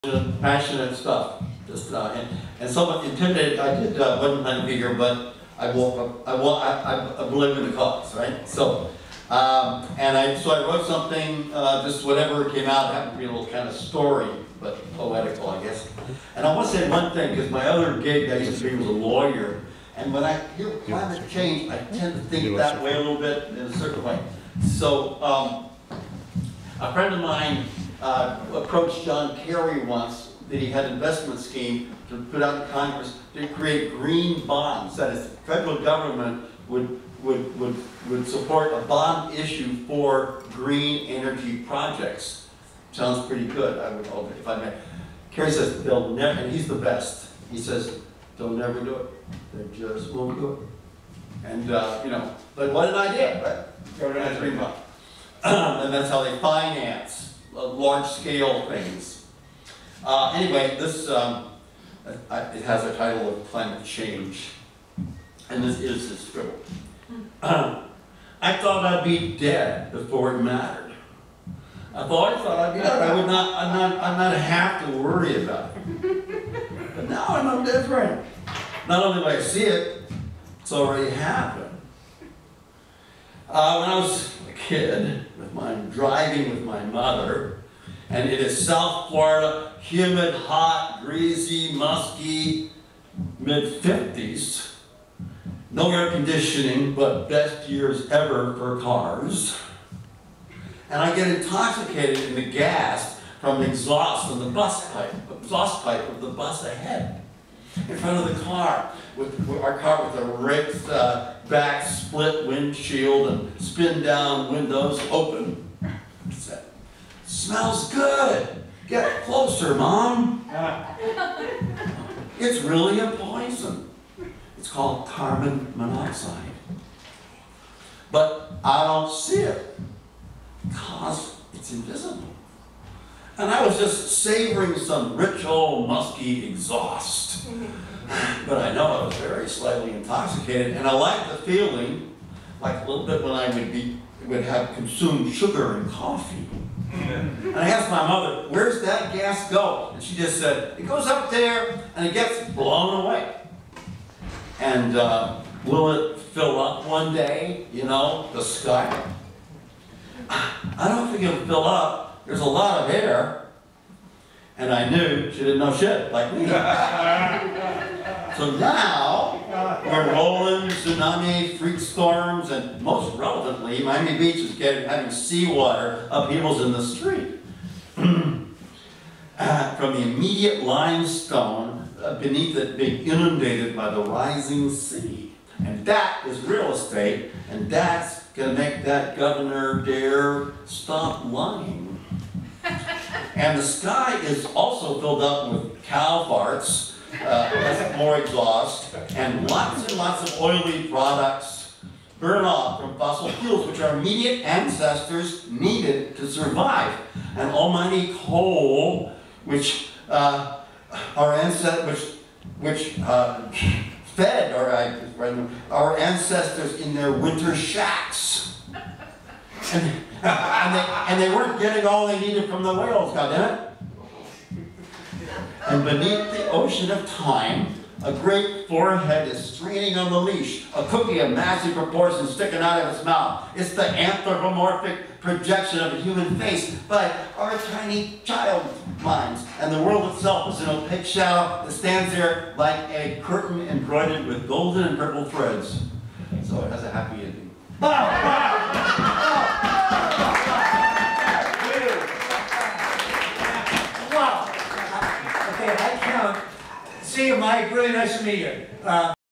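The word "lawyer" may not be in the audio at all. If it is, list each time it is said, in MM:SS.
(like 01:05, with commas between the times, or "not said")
00:18.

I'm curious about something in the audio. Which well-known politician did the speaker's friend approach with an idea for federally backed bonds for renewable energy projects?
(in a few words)
John Kerry.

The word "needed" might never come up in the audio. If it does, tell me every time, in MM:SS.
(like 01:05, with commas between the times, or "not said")
03:25, 03:42.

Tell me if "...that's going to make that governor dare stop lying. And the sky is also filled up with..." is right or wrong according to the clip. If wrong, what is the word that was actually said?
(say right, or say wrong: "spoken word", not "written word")
right.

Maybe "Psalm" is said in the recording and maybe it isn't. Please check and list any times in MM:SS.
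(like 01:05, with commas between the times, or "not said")
not said.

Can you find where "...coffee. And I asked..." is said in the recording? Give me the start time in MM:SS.
02:25.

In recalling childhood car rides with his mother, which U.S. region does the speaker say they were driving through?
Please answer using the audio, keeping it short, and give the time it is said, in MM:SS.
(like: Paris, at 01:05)
South Florida, at 01:28.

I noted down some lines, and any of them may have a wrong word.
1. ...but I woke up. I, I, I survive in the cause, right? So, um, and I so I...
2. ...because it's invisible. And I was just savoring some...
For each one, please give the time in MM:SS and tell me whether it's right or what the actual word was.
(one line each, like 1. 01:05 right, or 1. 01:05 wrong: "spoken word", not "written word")
1. 00:04 wrong: "believe", not "survive"
2. 02:10 right.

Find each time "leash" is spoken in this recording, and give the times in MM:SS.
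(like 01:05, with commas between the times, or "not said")
03:50.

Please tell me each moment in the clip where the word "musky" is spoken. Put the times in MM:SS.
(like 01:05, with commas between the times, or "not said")
01:31, 02:15.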